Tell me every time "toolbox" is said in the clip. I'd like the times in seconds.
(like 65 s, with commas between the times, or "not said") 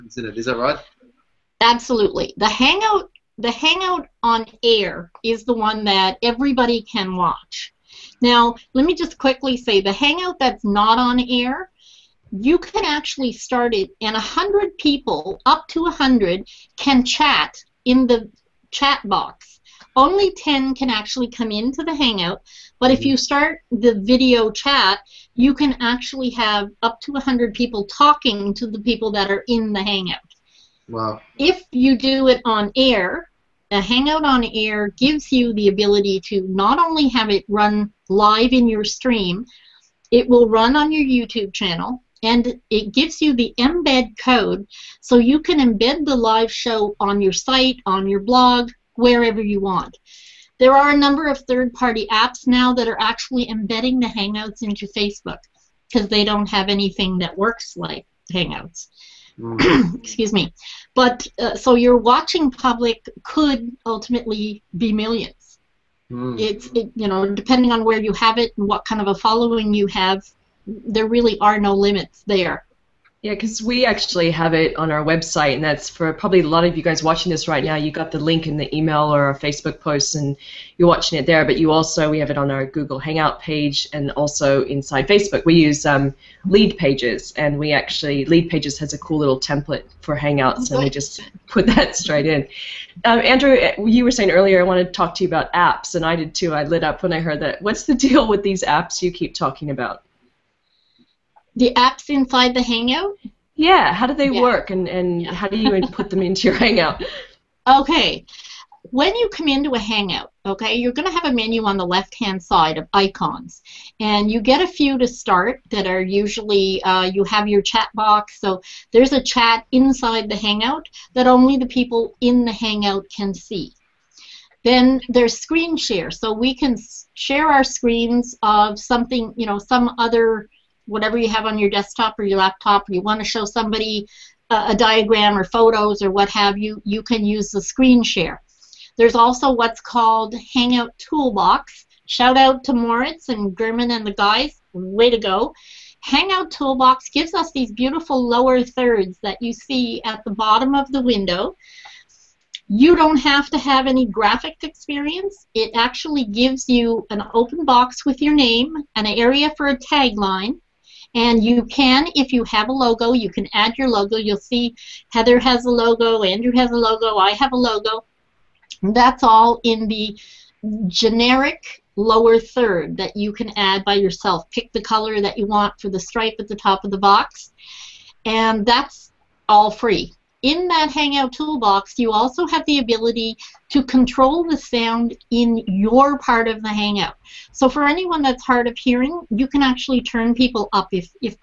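140 s, 146 s, 181 s.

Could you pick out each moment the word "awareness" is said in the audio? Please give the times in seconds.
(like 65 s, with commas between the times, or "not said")
not said.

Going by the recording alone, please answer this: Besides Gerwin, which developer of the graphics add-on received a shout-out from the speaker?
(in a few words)
Moritz.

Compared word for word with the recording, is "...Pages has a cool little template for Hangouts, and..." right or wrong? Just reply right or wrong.
right.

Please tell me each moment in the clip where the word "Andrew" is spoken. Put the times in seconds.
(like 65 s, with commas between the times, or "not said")
93 s, 166 s.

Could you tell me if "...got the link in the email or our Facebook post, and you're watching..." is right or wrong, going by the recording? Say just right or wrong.
right.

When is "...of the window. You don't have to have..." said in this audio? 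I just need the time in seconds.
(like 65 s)
150 s.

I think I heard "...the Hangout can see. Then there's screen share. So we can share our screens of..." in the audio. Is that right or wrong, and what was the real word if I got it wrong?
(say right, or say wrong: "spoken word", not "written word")
right.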